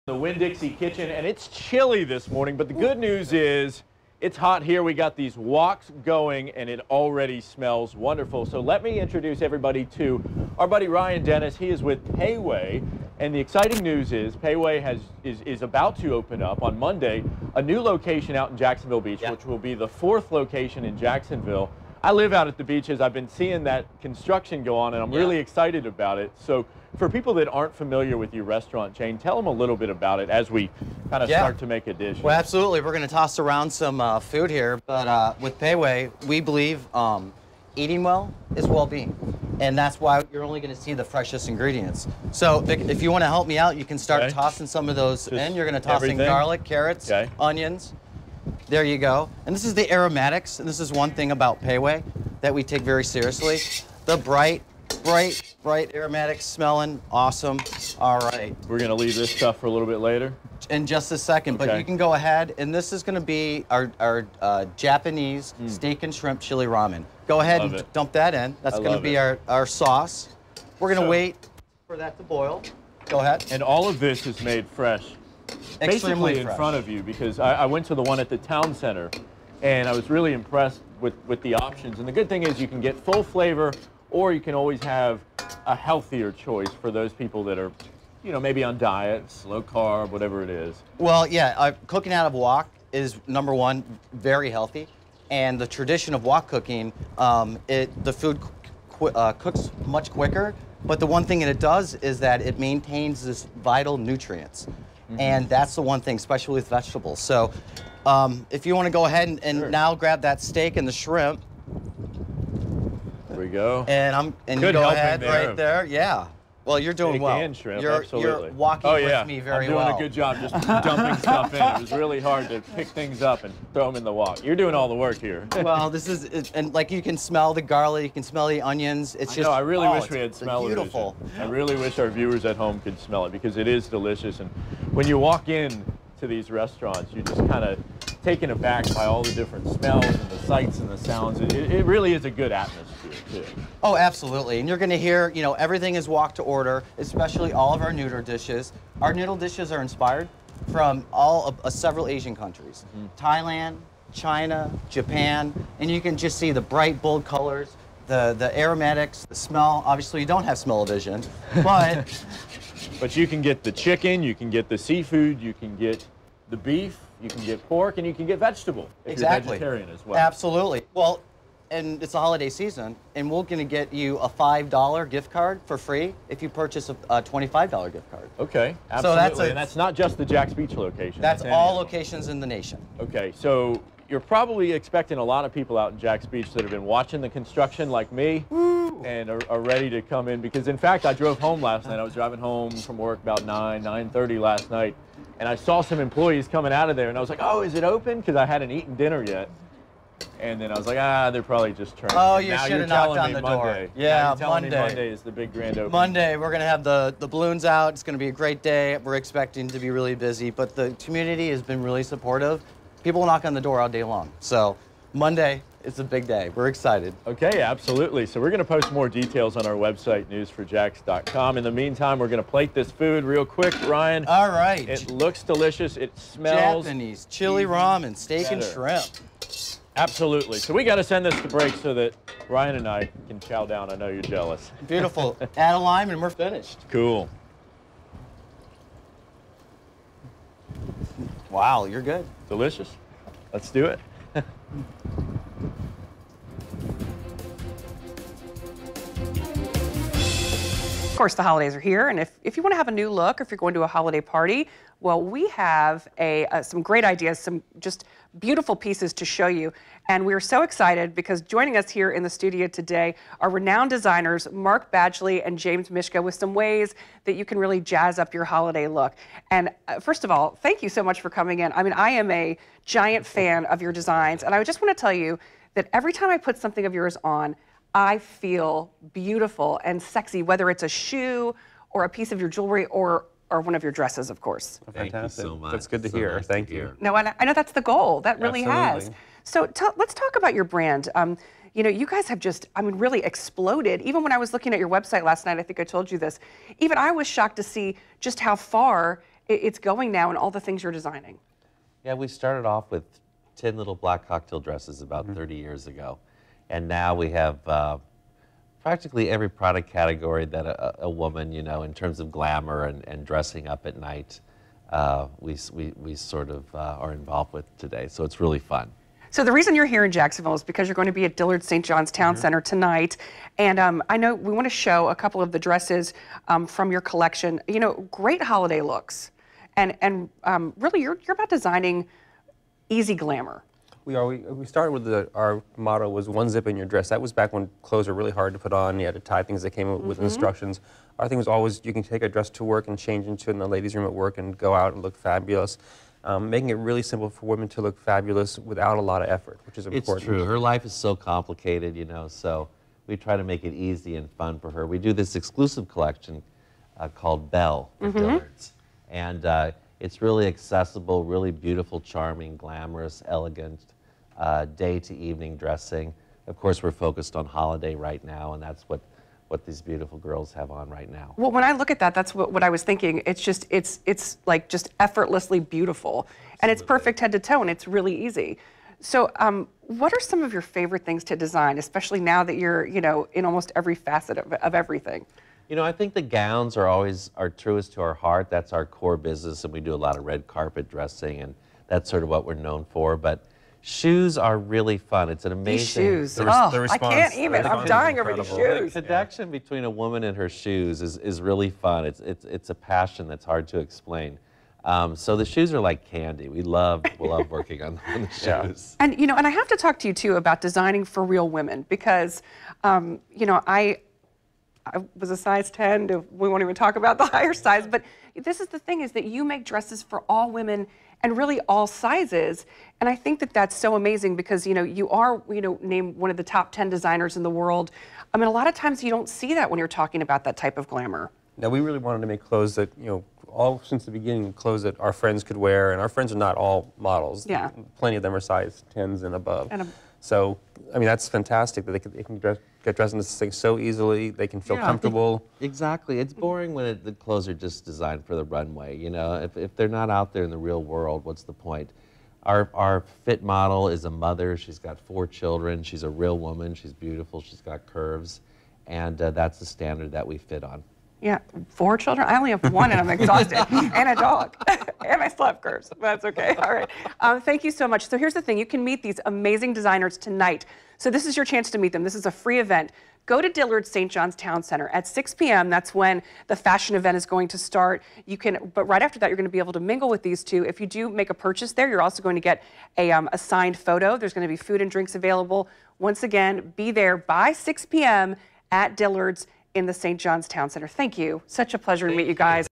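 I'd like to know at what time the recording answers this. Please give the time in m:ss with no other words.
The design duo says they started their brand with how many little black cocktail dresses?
5:03.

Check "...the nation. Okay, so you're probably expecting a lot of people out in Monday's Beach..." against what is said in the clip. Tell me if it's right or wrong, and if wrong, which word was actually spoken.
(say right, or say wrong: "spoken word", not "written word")
wrong: "Jack", not "Monday".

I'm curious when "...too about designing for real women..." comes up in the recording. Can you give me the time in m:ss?
6:50.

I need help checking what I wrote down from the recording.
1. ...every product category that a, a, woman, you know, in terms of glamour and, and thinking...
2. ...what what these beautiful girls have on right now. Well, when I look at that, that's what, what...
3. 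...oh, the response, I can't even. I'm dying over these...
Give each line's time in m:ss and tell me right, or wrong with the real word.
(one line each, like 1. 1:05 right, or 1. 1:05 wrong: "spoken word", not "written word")
1. 5:09 wrong: "dressing", not "thinking"
2. 6:08 right
3. 6:36 right.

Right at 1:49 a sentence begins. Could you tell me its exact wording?
now grab that steak and the shrimp, we go.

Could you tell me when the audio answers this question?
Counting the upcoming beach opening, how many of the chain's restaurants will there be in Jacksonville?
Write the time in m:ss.
0:19.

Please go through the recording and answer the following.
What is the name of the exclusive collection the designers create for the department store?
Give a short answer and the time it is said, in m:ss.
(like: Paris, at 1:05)
Belle, at 5:57.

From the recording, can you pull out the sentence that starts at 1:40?
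But the one thing that it does is that it maintains this vital nutrients.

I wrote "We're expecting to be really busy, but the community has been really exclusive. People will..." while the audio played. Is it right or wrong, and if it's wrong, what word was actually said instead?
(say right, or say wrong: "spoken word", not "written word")
wrong: "supportive", not "exclusive".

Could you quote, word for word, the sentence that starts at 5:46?
Um, making it really simple for women to look fabulous without a lot of effort, which is important.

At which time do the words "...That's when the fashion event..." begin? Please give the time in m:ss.
7:55.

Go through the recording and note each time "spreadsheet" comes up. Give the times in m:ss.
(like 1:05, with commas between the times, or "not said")
not said.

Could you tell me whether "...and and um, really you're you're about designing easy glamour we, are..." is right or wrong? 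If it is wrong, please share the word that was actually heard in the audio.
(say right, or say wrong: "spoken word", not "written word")
right.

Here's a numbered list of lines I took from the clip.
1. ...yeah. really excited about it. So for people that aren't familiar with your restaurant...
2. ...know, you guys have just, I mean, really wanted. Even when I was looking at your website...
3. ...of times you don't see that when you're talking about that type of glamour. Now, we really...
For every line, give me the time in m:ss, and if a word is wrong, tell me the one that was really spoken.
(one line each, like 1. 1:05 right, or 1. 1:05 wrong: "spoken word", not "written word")
1. 0:25 right
2. 4:51 wrong: "exploded", not "wanted"
3. 7:08 right.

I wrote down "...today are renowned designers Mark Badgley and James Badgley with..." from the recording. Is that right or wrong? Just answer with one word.
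wrong.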